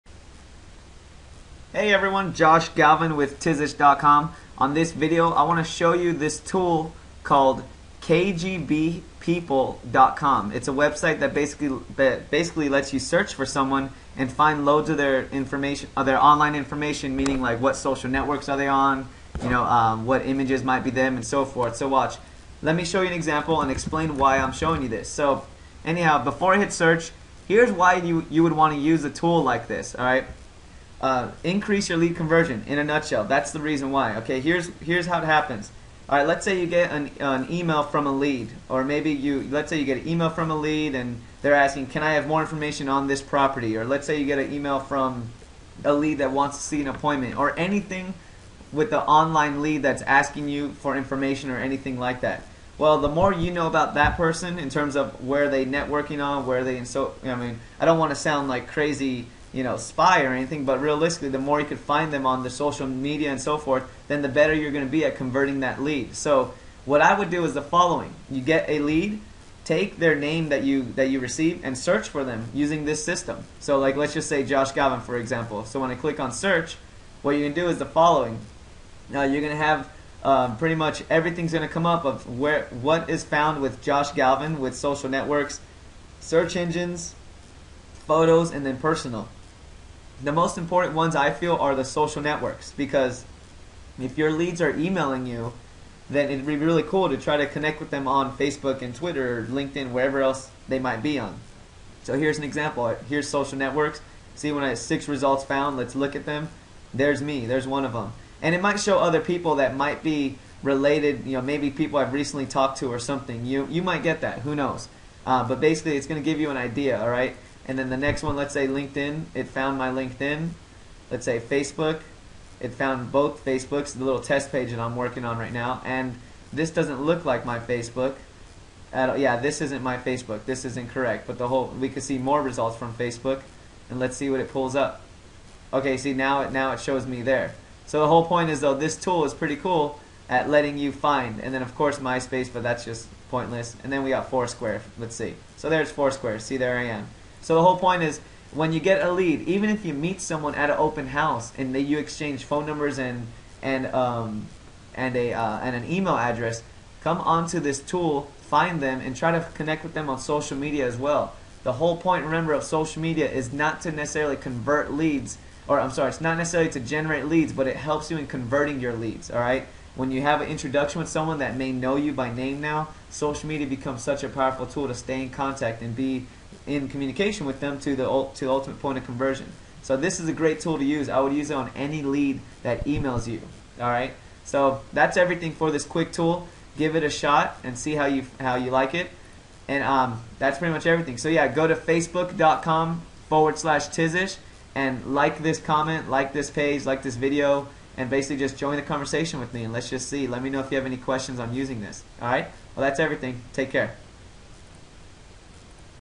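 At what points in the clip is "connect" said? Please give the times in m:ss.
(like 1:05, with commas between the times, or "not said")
1:37, 2:39.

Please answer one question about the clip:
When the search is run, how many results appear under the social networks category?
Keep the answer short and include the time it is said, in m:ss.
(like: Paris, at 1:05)
6, at 1:44.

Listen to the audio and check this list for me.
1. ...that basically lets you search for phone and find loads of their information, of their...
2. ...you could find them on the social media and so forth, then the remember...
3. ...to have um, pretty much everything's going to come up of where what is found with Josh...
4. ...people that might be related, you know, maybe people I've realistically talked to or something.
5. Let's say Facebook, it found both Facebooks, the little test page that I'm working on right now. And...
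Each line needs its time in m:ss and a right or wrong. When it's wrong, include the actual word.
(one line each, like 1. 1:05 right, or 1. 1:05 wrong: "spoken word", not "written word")
1. 0:11 wrong: "someone", not "phone"
2. 1:01 wrong: "better", not "remember"
3. 1:19 right
4. 1:49 wrong: "recently", not "realistically"
5. 2:01 right.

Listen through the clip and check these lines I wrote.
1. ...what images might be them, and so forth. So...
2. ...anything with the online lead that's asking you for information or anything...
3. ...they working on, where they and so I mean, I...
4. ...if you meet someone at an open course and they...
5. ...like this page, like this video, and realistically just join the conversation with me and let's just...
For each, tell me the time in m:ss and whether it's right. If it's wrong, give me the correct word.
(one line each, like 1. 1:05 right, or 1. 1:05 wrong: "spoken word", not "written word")
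1. 0:20 right
2. 0:47 right
3. 0:55 wrong: "networking", not "working"
4. 2:29 wrong: "house", not "course"
5. 3:16 wrong: "basically", not "realistically".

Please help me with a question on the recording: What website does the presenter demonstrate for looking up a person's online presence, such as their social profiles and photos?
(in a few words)
kgbpeople.com.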